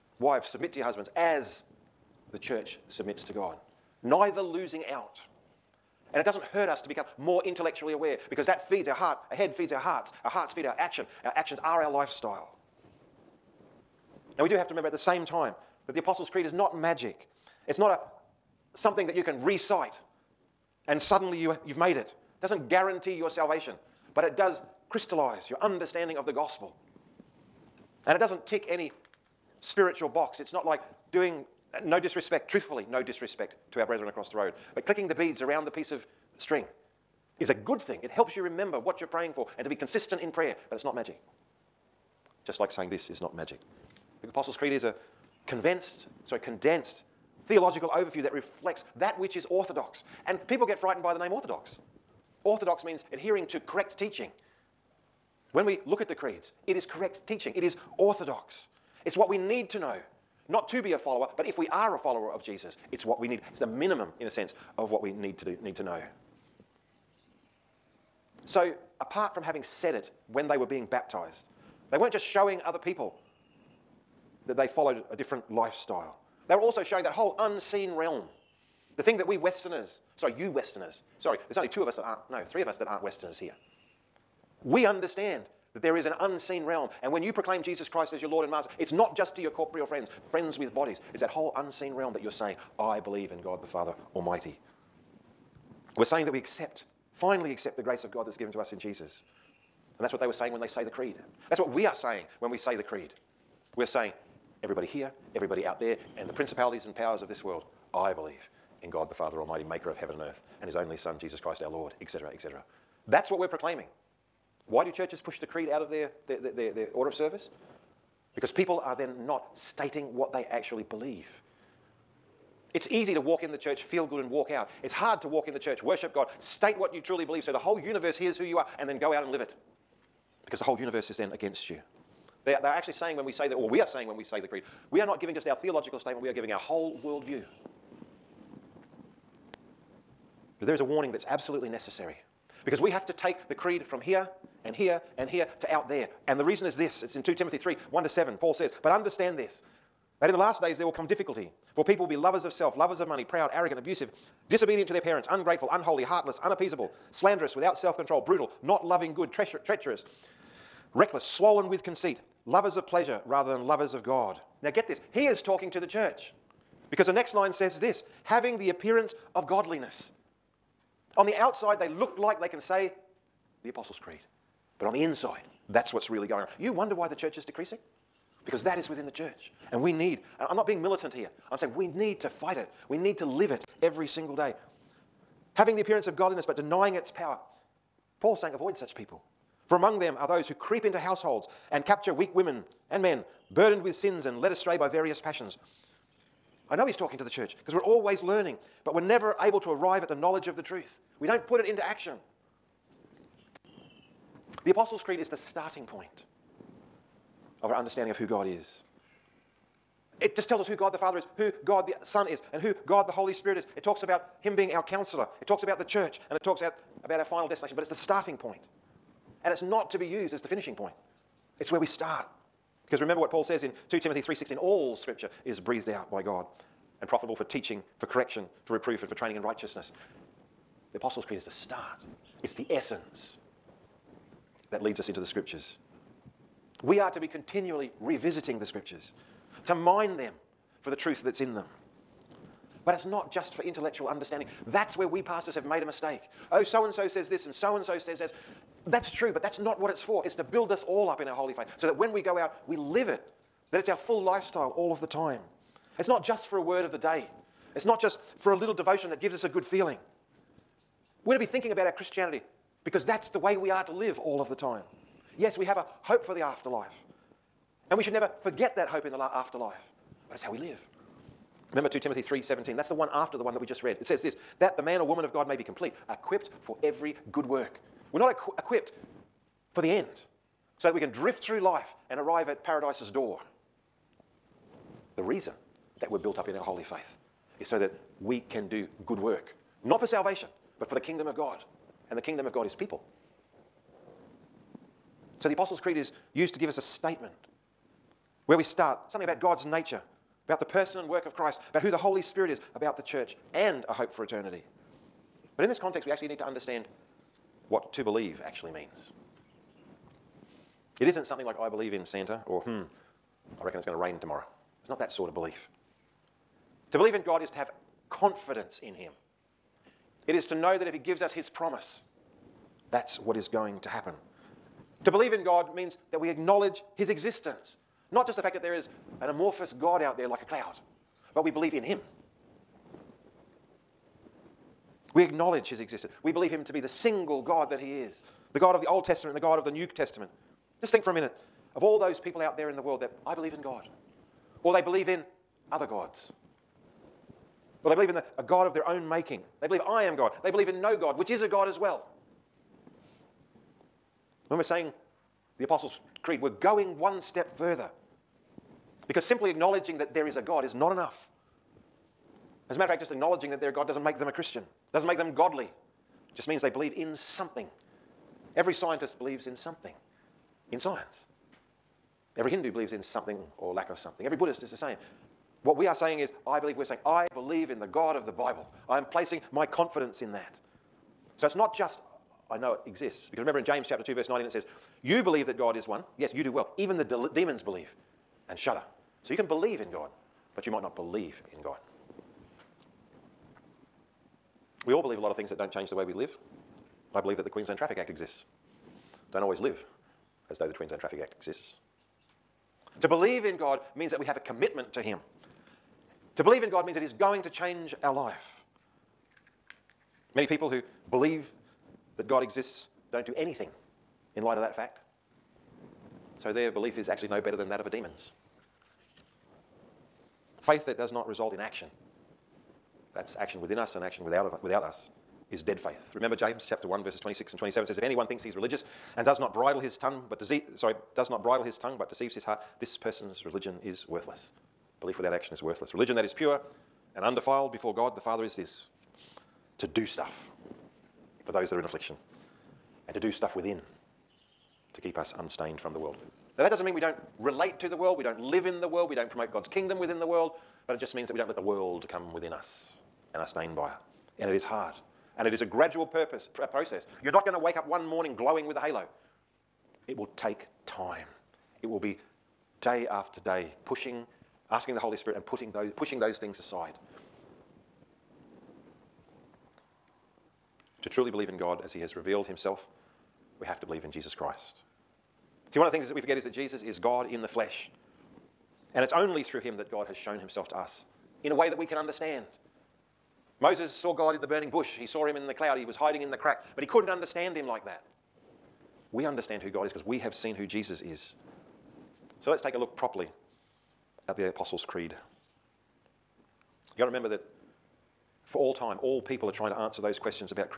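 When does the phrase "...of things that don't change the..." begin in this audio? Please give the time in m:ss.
6:35.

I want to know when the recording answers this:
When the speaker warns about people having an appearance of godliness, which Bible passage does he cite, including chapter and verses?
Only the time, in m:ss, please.
2:27.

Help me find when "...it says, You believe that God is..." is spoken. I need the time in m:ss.
6:24.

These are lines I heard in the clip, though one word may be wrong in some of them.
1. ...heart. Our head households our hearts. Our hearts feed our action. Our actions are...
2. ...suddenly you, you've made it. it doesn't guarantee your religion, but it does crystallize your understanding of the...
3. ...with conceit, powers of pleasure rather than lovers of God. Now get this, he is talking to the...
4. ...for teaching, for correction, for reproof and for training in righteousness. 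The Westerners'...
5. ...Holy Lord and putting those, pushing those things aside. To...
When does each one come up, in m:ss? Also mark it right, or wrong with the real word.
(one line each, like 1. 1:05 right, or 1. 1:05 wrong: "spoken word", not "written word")
1. 0:08 wrong: "feeds", not "households"
2. 0:21 wrong: "salvation", not "religion"
3. 2:41 wrong: "lovers", not "powers"
4. 3:47 wrong: "Apostles", not "Westerners"
5. 7:44 wrong: "Spirit", not "Lord".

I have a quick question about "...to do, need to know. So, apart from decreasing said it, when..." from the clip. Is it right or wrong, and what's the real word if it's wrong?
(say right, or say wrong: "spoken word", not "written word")
wrong: "having", not "decreasing".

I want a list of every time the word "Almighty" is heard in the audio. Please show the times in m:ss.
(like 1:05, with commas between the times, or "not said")
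1:34, 1:49.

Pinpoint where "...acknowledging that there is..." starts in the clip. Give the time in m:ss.
5:59.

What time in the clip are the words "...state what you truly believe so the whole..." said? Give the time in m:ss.
2:06.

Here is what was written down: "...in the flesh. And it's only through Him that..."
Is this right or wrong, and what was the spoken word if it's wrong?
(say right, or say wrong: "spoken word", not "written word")
right.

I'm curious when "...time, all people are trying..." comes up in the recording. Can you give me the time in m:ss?
8:18.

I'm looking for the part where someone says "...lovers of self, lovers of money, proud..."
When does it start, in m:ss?
2:32.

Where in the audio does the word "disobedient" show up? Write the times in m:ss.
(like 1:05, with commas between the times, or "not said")
2:34.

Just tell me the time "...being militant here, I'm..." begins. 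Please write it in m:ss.
3:00.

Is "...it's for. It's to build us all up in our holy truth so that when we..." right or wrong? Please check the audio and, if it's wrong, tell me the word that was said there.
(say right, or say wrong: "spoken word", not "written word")
wrong: "faith", not "truth".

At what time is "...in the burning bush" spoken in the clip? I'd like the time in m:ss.
8:04.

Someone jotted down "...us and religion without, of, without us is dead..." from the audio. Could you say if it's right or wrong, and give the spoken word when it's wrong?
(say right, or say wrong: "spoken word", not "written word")
wrong: "action", not "religion".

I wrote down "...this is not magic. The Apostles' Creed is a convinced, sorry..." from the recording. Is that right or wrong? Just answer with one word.
right.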